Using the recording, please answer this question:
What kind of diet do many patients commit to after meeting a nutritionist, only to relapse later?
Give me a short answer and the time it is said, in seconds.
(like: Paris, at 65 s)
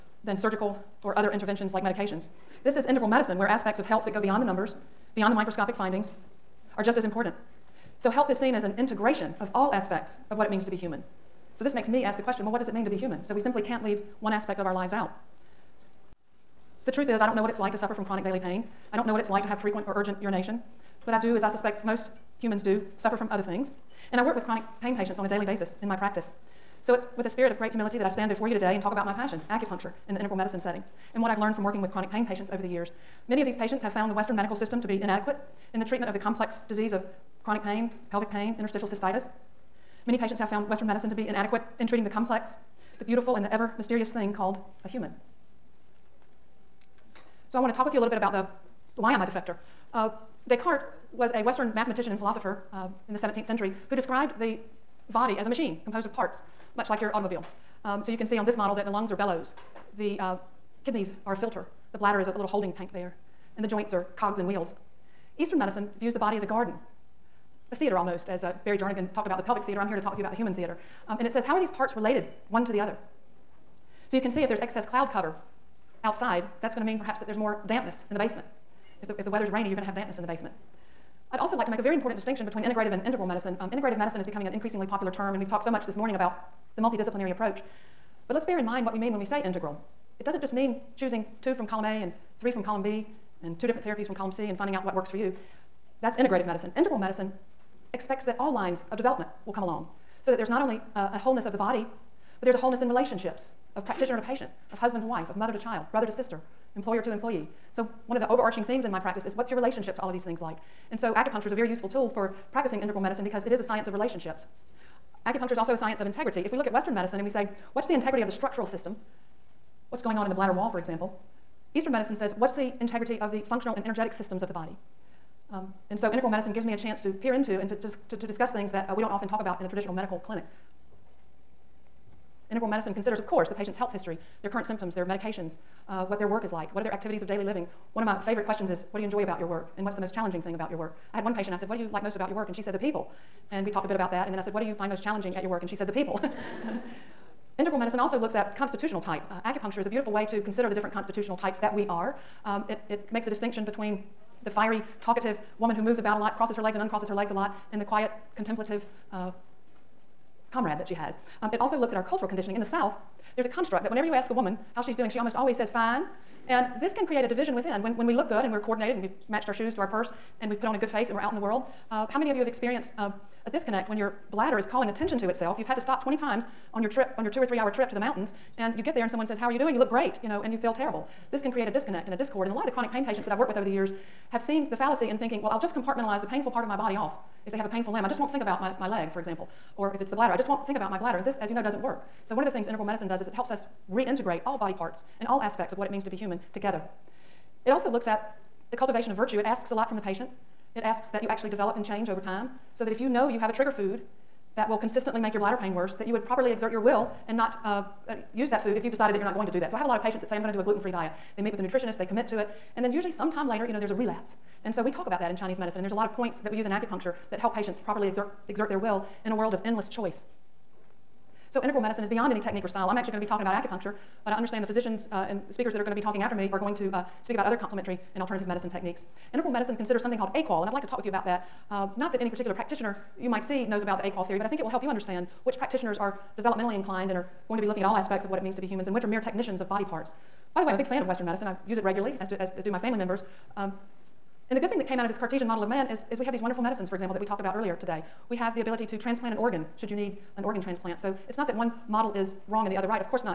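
Gluten free, at 210 s.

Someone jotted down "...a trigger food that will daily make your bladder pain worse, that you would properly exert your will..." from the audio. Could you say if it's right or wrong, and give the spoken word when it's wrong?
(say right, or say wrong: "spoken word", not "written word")
wrong: "consistently", not "daily".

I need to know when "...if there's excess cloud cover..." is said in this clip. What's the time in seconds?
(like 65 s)
74 s.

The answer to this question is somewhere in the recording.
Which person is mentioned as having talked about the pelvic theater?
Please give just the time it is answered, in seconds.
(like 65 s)
68 s.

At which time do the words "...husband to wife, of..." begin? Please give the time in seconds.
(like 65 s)
104 s.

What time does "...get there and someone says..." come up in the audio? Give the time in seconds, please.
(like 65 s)
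178 s.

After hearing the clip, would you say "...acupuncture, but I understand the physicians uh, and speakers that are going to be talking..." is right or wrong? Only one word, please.
right.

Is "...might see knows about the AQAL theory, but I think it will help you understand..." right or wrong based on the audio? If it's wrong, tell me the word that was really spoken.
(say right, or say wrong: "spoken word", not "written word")
right.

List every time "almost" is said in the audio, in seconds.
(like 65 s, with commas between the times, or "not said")
67 s, 165 s.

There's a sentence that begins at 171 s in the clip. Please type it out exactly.
Uh, how many of you have experienced uh, a disconnect when your bladder is calling attention to itself?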